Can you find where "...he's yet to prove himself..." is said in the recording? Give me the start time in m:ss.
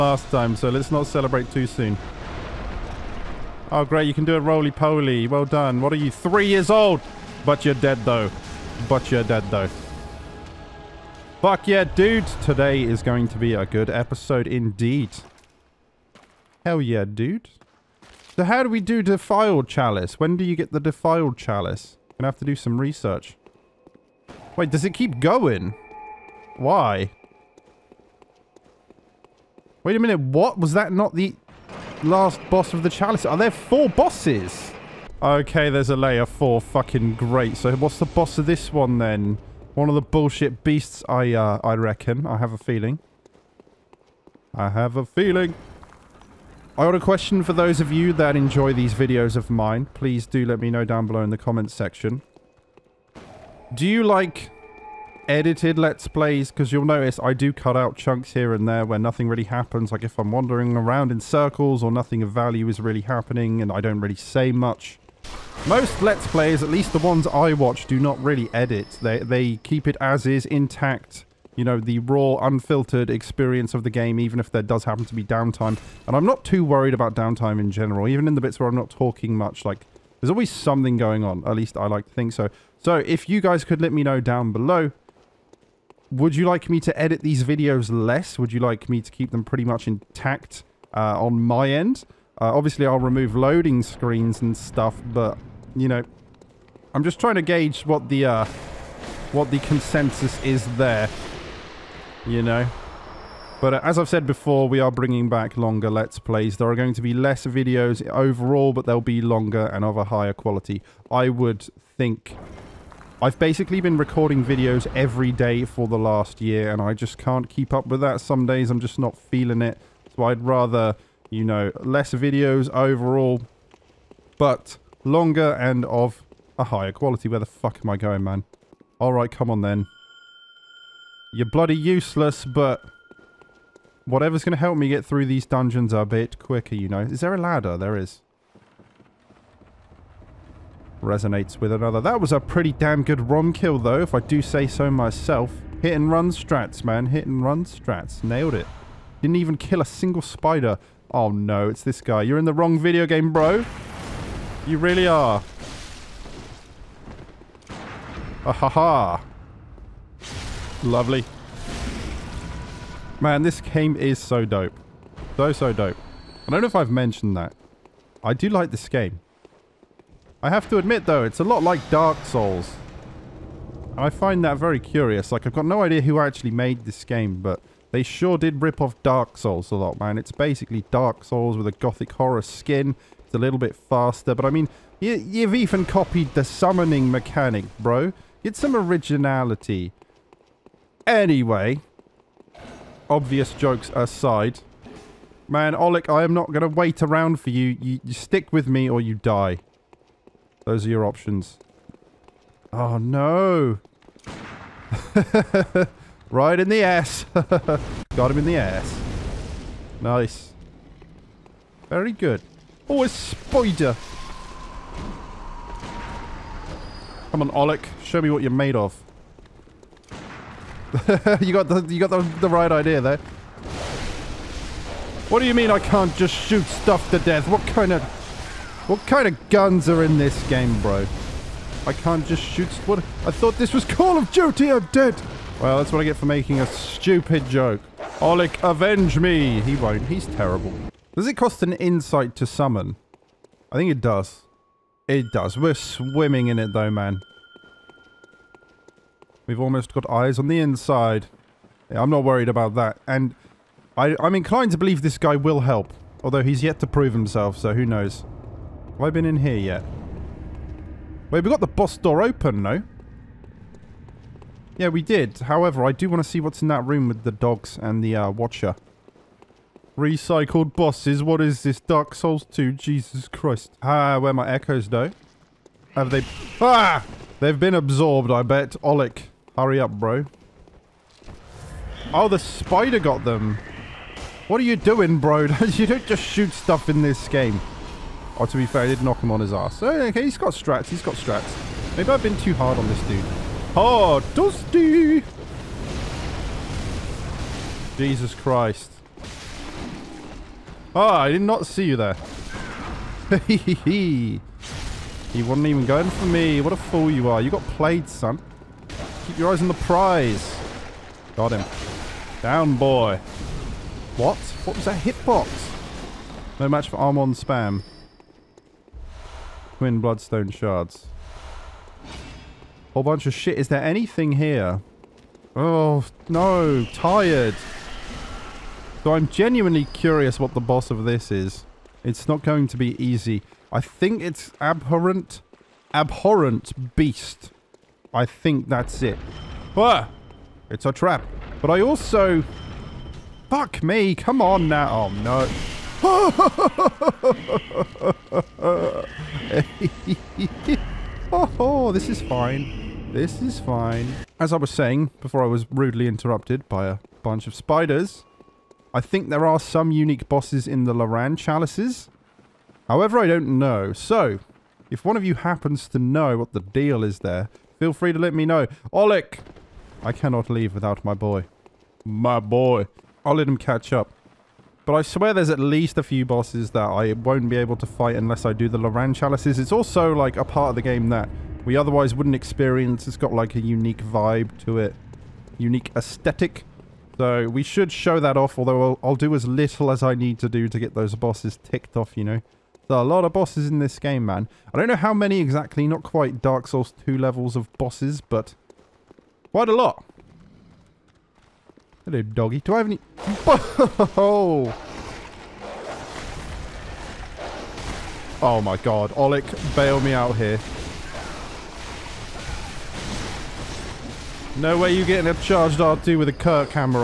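4:16.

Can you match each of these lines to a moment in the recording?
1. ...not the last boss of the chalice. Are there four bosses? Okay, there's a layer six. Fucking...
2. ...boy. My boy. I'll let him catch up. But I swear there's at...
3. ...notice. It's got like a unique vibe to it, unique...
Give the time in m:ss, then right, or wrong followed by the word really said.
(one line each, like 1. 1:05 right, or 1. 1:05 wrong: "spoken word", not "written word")
1. 0:30 wrong: "four", not "six"
2. 6:11 right
3. 6:22 wrong: "experience", not "notice".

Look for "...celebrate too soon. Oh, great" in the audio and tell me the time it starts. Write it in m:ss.
0:01.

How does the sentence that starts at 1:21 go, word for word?
At least I like to think so.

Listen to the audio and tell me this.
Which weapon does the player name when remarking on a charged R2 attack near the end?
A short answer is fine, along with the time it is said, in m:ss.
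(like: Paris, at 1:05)
Kirkhammer, at 6:56.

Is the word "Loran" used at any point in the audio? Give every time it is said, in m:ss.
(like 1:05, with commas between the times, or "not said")
6:00, 6:18.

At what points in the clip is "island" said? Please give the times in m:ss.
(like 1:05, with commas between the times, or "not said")
not said.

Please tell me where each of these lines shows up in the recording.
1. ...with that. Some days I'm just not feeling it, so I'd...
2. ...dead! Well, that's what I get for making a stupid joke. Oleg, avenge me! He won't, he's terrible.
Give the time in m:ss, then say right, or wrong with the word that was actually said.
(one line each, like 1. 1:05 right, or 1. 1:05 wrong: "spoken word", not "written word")
1. 1:57 right
2. 3:54 right.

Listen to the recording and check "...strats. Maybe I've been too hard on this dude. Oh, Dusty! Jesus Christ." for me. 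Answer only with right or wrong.
right.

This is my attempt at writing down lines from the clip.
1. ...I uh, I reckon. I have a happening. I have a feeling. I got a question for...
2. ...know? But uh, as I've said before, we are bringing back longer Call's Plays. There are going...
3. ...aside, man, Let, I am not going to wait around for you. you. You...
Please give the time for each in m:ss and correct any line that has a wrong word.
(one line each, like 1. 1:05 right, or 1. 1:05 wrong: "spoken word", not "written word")
1. 0:41 wrong: "feeling", not "happening"
2. 1:42 wrong: "Let", not "Call"
3. 3:13 wrong: "Oleg", not "Let".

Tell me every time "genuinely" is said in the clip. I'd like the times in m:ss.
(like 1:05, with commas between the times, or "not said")
5:29.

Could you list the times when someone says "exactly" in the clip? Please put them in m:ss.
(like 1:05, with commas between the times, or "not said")
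6:35.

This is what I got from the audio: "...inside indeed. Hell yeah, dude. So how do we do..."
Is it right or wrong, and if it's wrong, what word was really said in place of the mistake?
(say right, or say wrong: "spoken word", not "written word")
wrong: "episode", not "inside".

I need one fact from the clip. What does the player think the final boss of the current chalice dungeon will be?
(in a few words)
Abhorrent beast.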